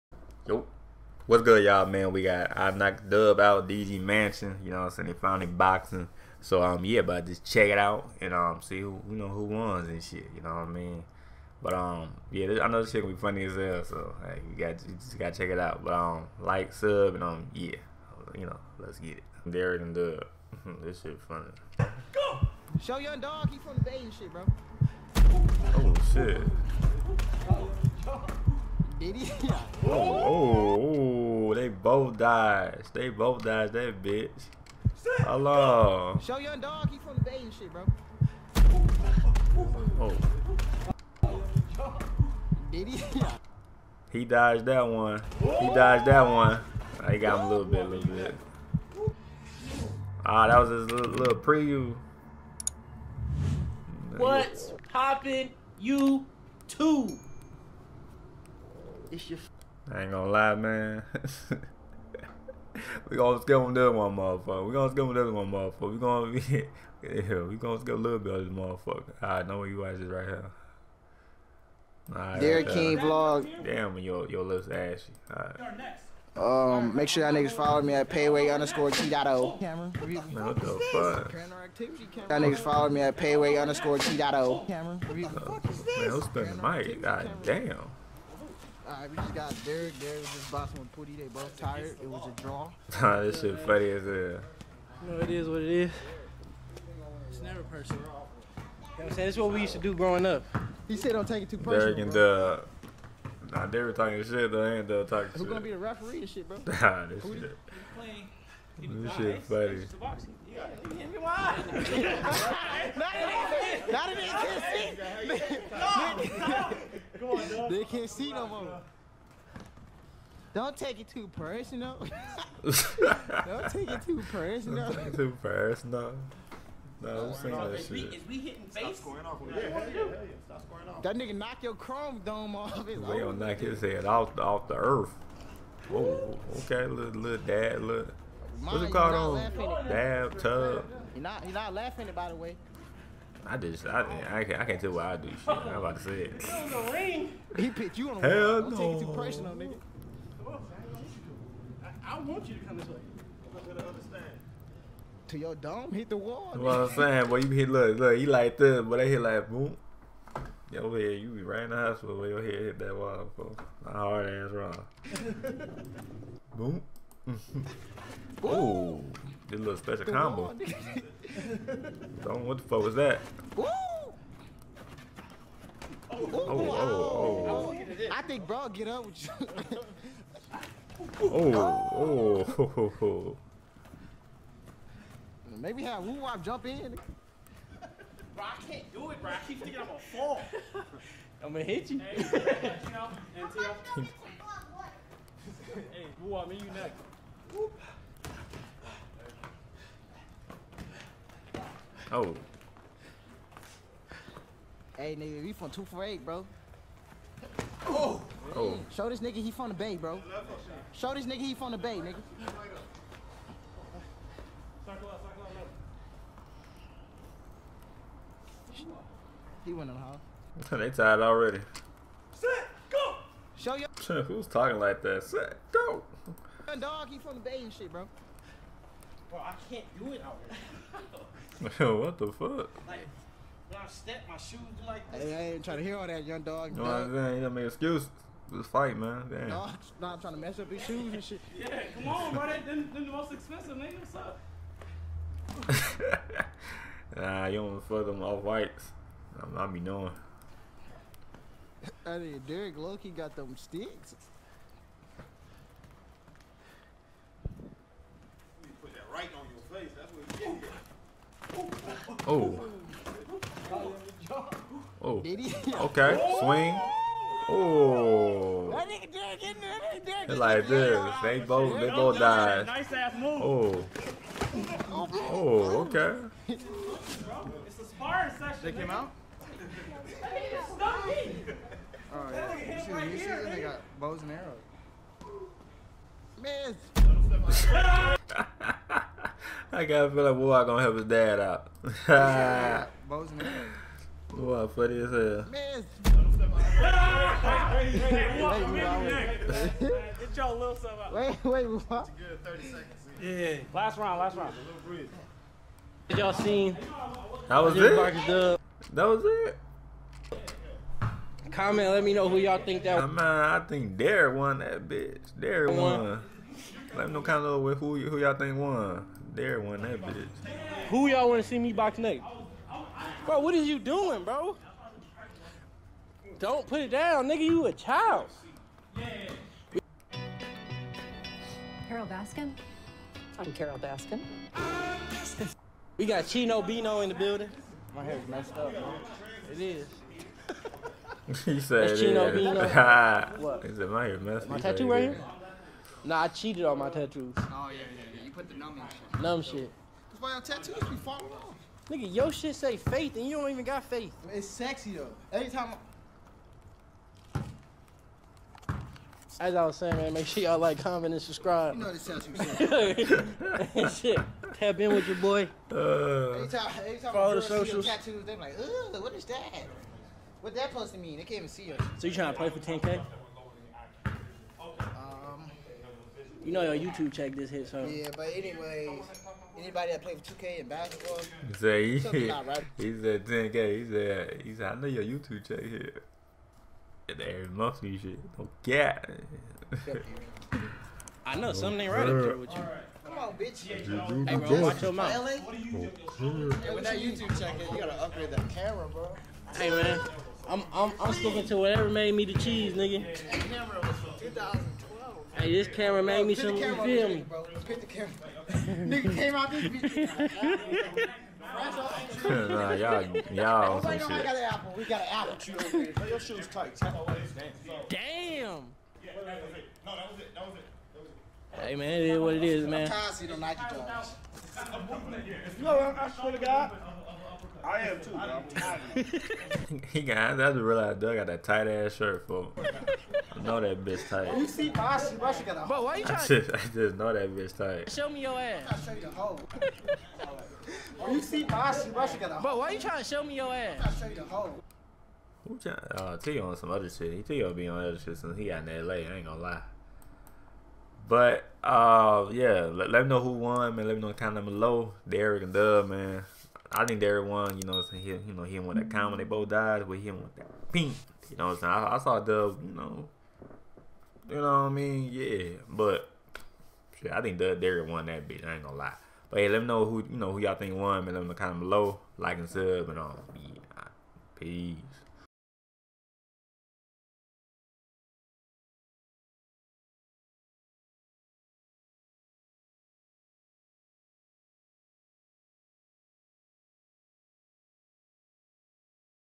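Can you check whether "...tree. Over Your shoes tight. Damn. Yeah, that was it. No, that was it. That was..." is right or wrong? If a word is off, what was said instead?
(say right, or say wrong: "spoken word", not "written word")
right.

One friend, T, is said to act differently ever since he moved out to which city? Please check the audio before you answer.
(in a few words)
LA.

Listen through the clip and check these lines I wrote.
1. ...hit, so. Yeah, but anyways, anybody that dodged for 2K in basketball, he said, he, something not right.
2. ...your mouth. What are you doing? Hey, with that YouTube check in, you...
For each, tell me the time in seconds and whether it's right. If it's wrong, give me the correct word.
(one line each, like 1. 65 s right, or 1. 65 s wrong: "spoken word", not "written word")
1. 377 s wrong: "played", not "dodged"
2. 394 s right.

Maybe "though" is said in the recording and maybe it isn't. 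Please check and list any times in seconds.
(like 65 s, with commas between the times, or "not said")
104 s, 354 s.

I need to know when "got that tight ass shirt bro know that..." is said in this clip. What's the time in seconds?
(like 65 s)
431 s.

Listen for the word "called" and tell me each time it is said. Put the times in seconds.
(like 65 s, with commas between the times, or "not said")
138 s.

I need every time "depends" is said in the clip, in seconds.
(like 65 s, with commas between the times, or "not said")
not said.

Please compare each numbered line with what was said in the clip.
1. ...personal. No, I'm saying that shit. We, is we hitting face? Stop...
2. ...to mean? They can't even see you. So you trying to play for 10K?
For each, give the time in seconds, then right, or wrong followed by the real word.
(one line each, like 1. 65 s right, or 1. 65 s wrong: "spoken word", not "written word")
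1. 125 s right
2. 370 s right.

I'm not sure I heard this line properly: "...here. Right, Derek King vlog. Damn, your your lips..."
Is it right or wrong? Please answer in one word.
right.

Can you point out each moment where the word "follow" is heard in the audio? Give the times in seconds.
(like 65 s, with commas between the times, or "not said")
77 s, 82 s, 367 s.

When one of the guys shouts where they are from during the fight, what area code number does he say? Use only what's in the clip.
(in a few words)
248.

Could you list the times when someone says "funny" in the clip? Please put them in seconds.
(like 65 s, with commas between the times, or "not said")
13 s, 21 s, 93 s, 109 s, 294 s.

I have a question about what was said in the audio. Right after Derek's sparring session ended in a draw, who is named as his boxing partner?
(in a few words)
Putty.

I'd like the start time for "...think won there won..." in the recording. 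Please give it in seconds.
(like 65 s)
318 s.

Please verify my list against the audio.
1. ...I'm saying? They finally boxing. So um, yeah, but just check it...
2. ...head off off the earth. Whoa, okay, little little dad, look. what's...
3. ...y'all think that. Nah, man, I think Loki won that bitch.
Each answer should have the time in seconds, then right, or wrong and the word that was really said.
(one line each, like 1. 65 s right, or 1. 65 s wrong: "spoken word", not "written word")
1. 4 s right
2. 133 s right
3. 312 s wrong: "Derek", not "Loki".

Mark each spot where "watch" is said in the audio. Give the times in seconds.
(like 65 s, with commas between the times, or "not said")
69 s, 394 s.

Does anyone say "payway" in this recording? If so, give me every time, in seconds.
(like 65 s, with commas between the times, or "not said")
78 s, 83 s.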